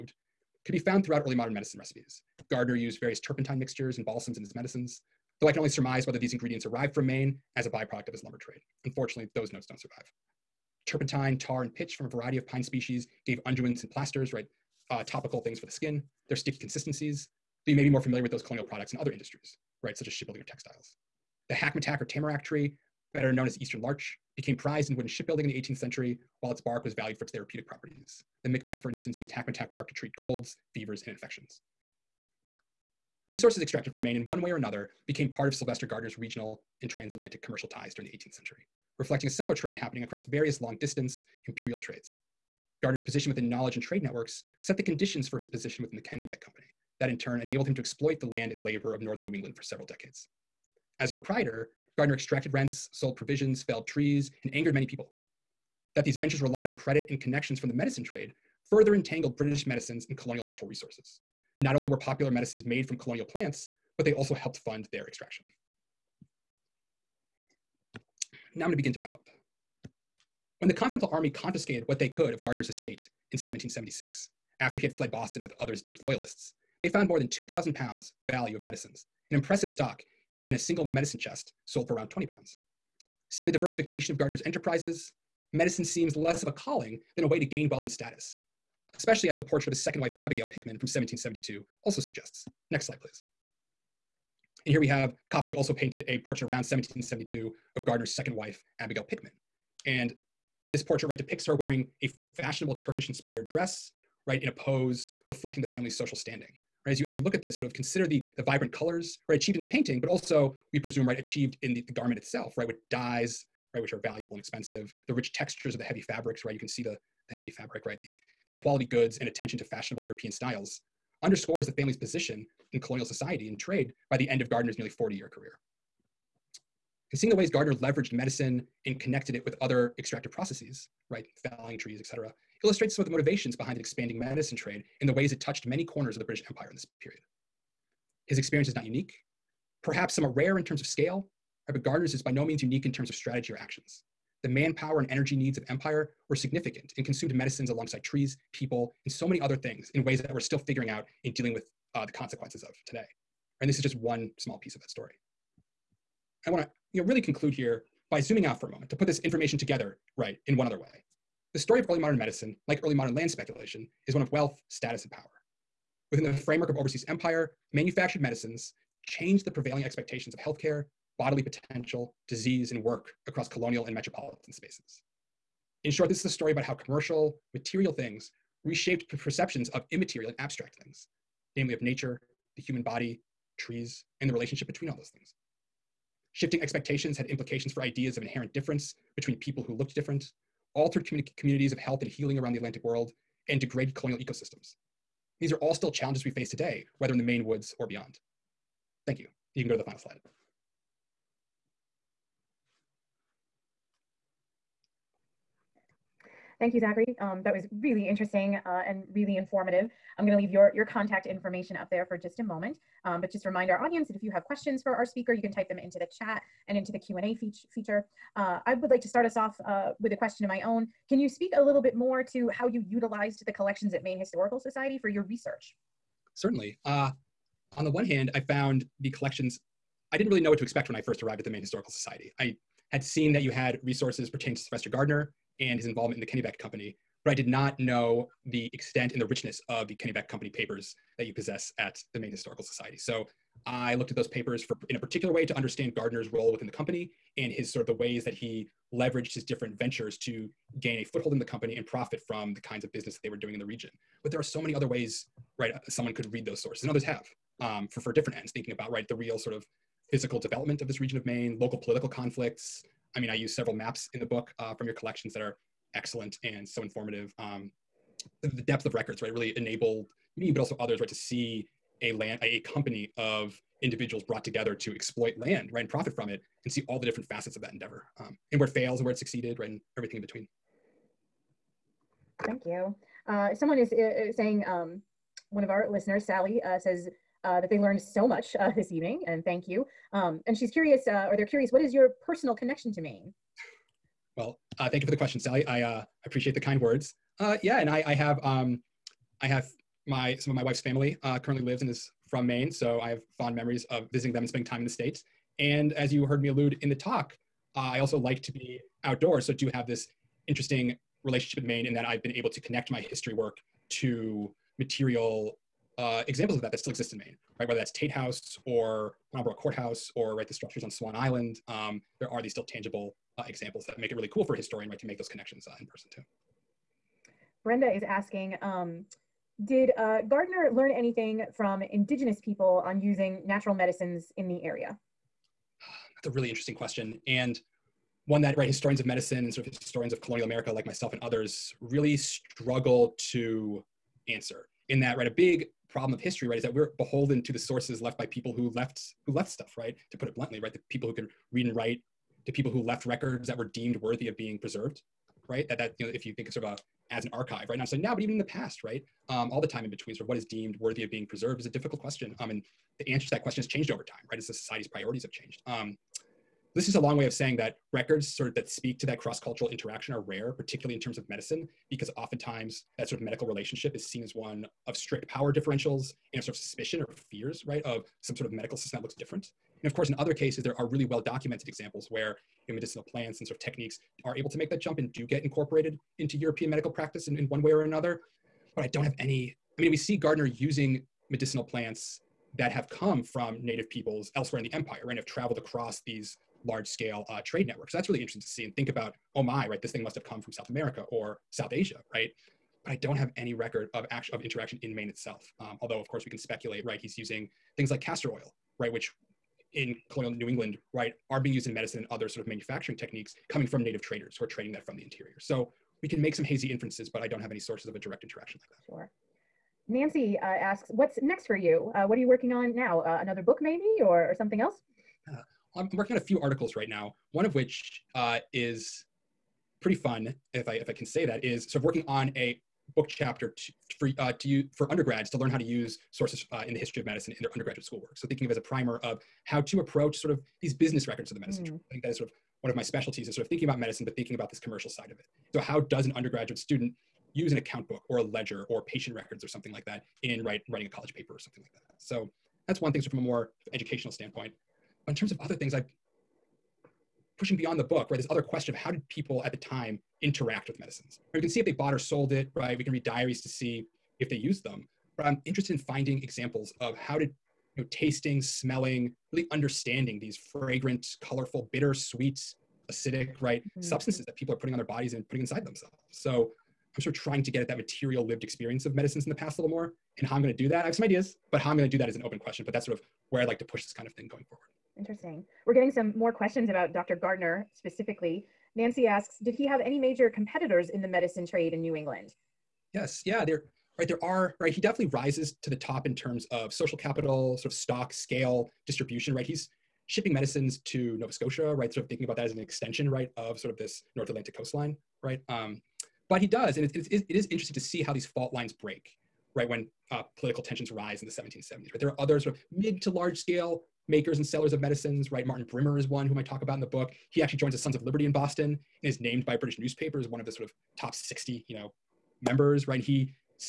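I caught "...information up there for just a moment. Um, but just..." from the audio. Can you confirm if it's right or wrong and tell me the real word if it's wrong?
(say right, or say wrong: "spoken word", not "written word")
right.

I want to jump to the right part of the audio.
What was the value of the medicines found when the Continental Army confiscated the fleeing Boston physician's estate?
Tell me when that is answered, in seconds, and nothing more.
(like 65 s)
77 s.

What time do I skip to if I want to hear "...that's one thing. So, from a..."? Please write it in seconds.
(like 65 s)
452 s.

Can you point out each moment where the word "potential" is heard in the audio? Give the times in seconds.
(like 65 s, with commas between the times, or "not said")
171 s.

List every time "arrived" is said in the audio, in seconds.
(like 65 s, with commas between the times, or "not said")
6 s, 231 s.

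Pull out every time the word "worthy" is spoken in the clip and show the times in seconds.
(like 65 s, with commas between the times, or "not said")
353 s, 360 s.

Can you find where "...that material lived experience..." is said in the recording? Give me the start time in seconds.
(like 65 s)
477 s.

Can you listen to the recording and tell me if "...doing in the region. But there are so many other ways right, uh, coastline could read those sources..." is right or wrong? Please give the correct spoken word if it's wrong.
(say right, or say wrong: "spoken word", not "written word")
wrong: "someone", not "coastline".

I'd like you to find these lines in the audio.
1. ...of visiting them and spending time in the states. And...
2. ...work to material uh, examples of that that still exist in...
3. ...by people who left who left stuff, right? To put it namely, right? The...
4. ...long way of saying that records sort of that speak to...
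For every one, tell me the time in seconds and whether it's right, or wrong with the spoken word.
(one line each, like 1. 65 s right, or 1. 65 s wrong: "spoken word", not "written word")
1. 303 s right
2. 313 s right
3. 348 s wrong: "bluntly", not "namely"
4. 366 s right.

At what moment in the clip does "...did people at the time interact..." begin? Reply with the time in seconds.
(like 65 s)
458 s.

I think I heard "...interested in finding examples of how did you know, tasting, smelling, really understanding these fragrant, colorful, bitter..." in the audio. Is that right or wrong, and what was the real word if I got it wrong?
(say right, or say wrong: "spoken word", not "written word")
right.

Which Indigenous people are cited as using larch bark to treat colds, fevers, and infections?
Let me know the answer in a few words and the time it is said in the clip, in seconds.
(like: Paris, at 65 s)
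Micmac, at 28 s.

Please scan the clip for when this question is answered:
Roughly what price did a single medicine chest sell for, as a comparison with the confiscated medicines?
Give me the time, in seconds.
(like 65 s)
82 s.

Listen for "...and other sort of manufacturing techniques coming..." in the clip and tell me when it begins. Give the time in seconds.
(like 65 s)
411 s.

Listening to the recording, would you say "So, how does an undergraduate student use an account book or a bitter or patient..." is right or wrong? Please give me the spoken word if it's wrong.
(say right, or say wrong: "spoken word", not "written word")
wrong: "ledger", not "bitter".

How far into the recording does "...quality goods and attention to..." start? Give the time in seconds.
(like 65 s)
118 s.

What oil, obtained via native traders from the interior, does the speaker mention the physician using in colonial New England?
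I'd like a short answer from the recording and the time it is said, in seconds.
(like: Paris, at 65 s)
Castor oil, at 408 s.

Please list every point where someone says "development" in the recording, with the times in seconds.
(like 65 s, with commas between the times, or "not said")
260 s.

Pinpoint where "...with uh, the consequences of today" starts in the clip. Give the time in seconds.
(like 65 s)
151 s.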